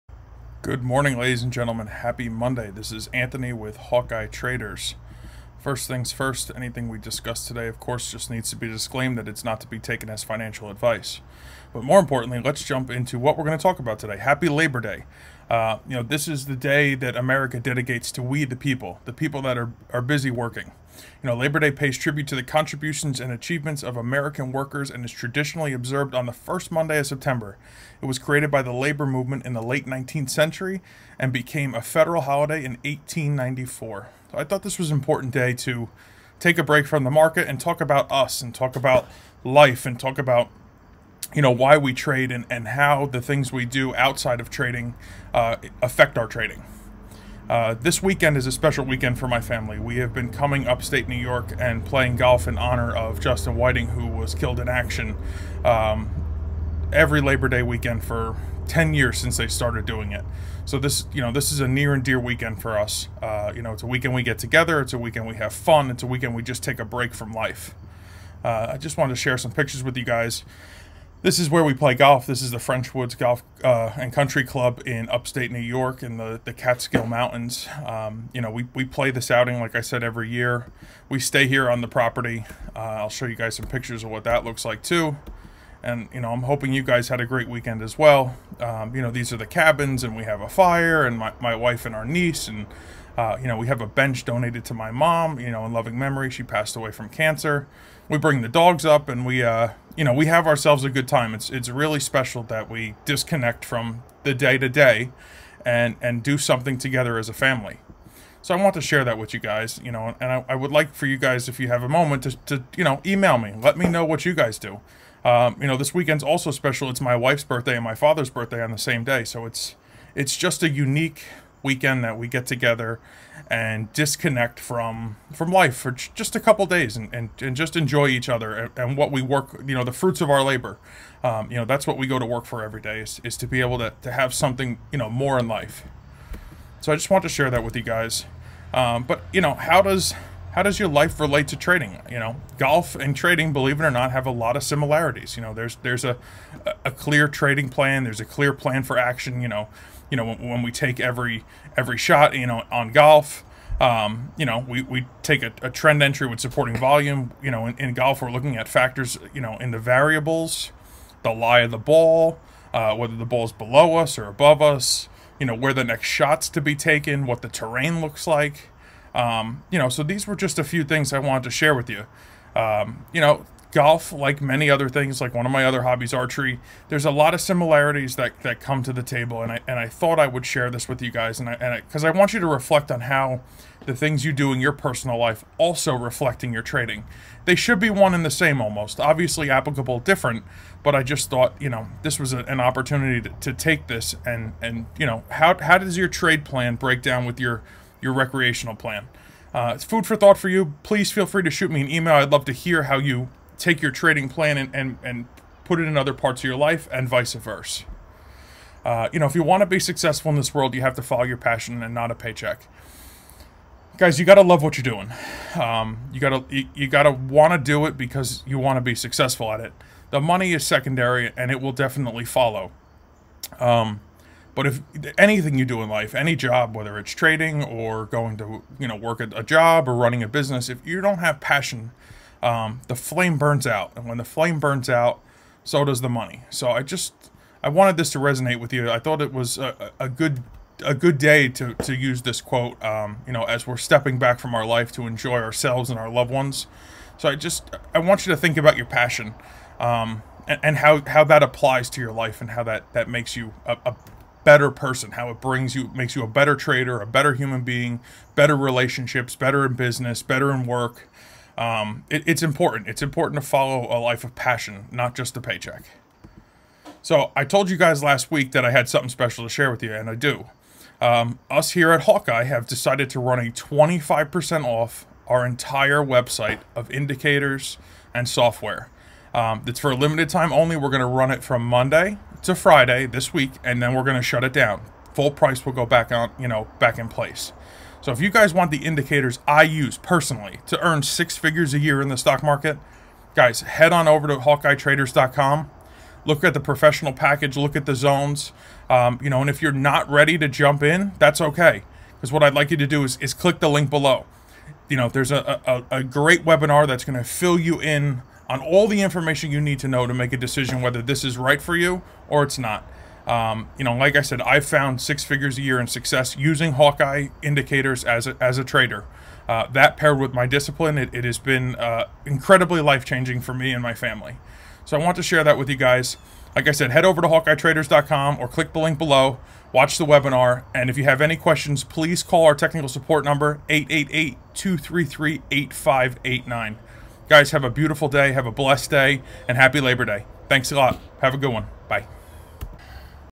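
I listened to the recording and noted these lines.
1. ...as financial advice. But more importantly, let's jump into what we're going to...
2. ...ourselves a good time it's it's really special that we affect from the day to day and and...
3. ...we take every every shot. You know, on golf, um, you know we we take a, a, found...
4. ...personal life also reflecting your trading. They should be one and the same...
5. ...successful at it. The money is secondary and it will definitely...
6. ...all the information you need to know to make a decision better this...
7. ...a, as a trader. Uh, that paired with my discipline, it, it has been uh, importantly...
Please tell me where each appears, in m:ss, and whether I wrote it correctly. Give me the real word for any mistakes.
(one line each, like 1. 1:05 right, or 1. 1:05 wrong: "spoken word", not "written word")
1. 0:10 right
2. 1:40 wrong: "disconnect", not "affect"
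3. 2:30 wrong: "trend", not "found"
4. 3:04 right
5. 3:38 right
6. 5:08 wrong: "whether", not "better"
7. 5:18 wrong: "incredibly", not "importantly".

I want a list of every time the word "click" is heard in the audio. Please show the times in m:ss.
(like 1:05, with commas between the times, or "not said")
5:03, 5:28.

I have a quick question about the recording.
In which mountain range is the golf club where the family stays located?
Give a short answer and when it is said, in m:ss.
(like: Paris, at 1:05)
Catskill Mountains, at 1:16.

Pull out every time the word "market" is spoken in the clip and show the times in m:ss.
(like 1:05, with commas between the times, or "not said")
0:37, 4:52.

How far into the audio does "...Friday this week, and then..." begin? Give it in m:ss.
4:42.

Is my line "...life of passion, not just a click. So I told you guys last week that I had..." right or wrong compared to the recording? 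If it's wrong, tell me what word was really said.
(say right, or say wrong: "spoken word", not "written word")
wrong: "paycheck", not "click".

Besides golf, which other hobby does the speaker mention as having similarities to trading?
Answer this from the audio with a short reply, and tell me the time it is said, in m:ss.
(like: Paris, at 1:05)
archery, at 2:56.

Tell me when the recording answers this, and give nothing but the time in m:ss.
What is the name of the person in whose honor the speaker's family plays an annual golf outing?
0:53.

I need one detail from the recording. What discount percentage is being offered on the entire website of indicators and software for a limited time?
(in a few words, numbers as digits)
25%.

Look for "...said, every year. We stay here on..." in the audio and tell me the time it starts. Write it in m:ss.
1:19.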